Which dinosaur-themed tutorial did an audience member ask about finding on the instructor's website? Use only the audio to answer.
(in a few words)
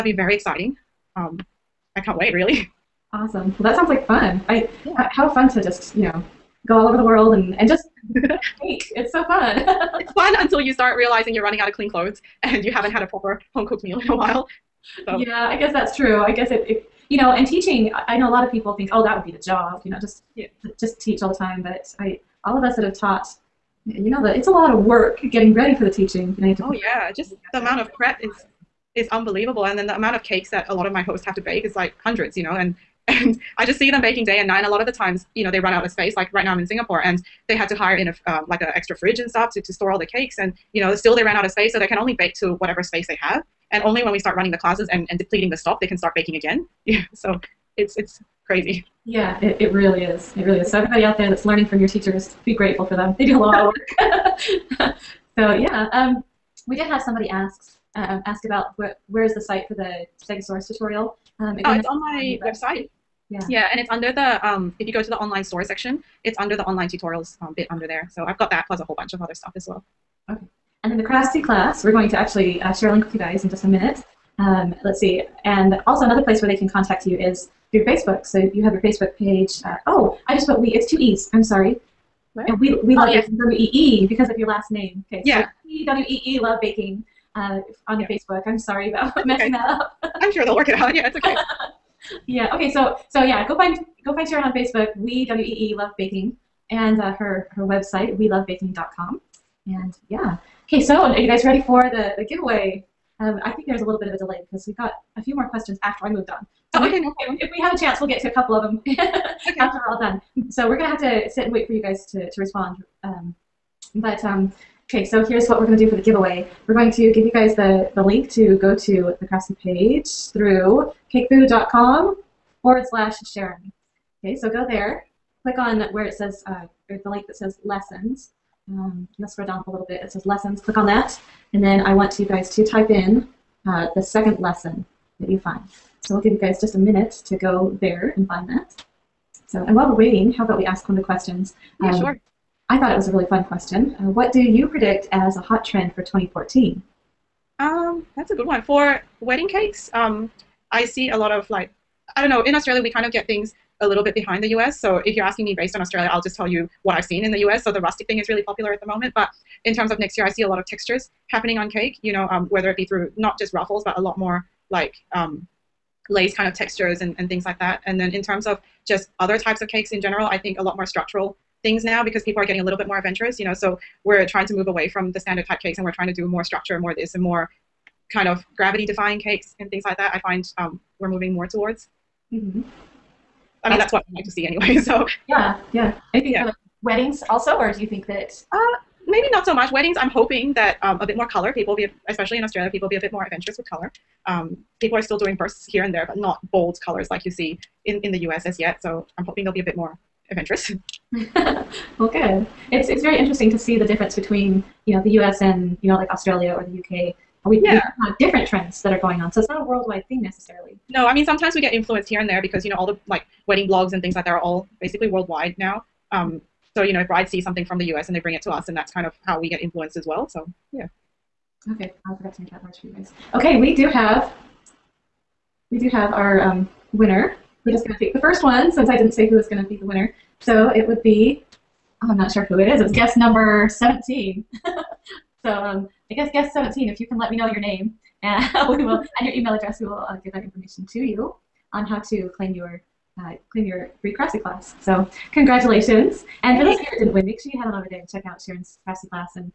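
Stegosaurus.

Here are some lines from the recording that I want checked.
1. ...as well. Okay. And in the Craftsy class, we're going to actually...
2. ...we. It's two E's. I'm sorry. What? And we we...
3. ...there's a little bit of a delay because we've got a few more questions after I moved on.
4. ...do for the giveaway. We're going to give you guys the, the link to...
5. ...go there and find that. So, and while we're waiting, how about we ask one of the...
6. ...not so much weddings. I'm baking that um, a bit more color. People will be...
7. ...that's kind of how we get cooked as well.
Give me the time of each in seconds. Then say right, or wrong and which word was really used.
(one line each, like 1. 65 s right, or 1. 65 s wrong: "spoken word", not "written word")
1. 69 s right
2. 80 s right
3. 103 s right
4. 115 s right
5. 137 s right
6. 189 s wrong: "hoping", not "baking"
7. 218 s wrong: "influenced", not "cooked".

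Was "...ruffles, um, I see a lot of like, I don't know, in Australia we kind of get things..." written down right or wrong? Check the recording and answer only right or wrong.
wrong.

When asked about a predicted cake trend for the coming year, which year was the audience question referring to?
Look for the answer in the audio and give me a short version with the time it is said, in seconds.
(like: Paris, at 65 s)
2014, at 146 s.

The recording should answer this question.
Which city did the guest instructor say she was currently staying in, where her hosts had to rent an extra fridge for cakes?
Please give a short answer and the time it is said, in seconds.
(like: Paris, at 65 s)
Singapore, at 36 s.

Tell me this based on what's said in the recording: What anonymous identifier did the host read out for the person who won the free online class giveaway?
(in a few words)
Guest number 17.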